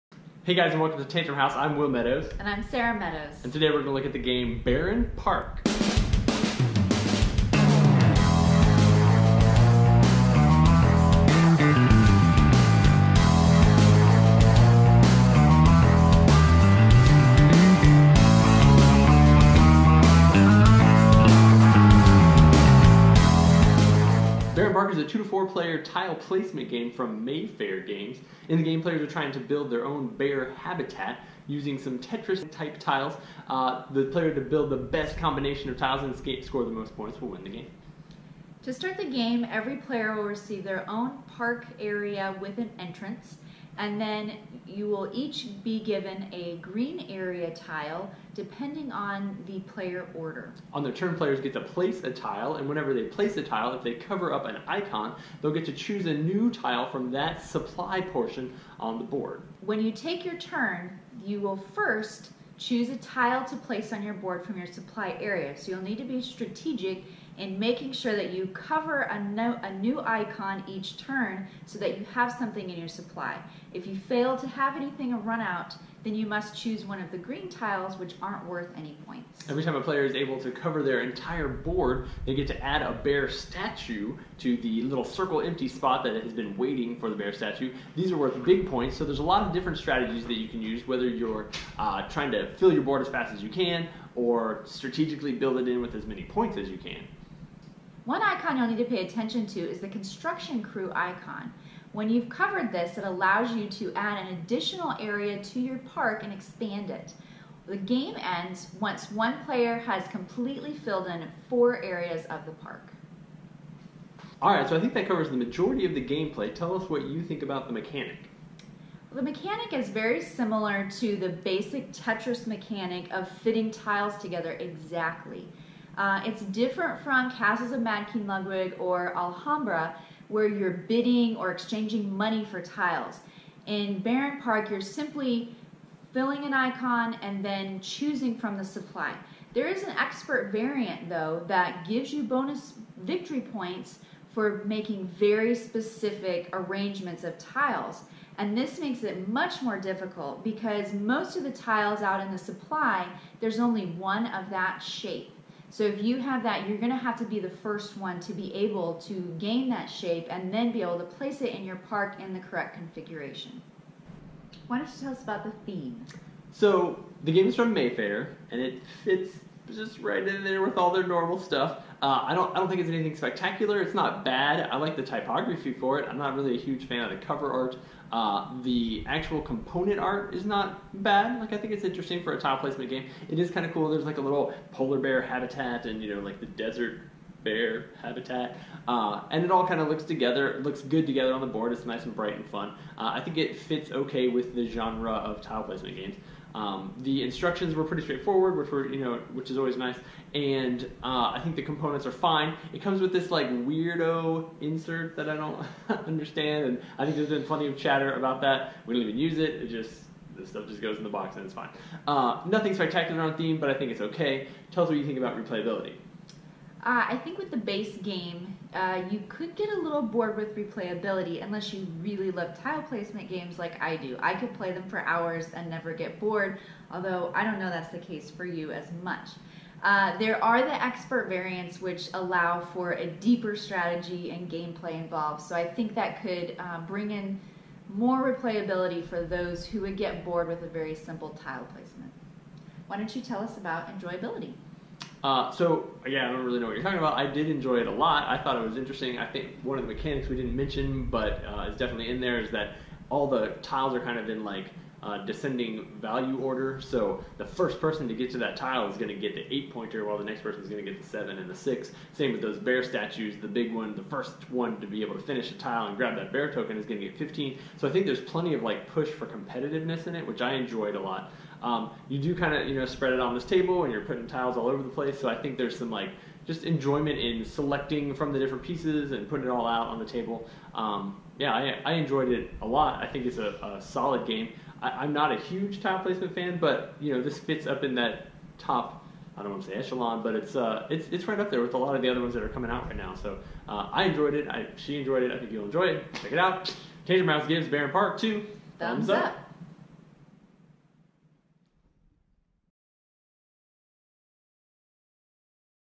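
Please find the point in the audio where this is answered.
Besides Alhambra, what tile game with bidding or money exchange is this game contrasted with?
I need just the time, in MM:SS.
02:07.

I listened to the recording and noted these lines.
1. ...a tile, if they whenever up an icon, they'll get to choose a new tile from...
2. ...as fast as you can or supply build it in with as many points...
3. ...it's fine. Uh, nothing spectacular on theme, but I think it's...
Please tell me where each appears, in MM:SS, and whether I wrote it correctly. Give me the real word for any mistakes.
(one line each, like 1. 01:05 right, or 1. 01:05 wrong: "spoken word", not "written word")
1. 00:53 wrong: "cover", not "whenever"
2. 01:33 wrong: "strategically", not "supply"
3. 03:31 right.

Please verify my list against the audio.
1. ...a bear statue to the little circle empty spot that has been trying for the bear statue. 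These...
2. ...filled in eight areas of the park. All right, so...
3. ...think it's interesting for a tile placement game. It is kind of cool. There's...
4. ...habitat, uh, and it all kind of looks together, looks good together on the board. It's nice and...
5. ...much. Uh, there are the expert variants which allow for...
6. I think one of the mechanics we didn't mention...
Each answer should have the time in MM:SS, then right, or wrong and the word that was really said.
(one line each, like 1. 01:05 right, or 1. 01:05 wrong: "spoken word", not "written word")
1. 01:22 wrong: "waiting", not "trying"
2. 01:50 wrong: "four", not "eight"
3. 03:01 right
4. 03:08 right
5. 03:49 right
6. 04:09 right.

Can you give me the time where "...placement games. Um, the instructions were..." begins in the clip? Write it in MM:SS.
03:15.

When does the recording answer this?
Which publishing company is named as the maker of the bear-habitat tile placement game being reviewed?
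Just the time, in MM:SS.
00:27.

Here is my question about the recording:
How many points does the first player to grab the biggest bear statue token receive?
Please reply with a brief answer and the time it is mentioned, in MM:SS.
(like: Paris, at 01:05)
15, at 04:27.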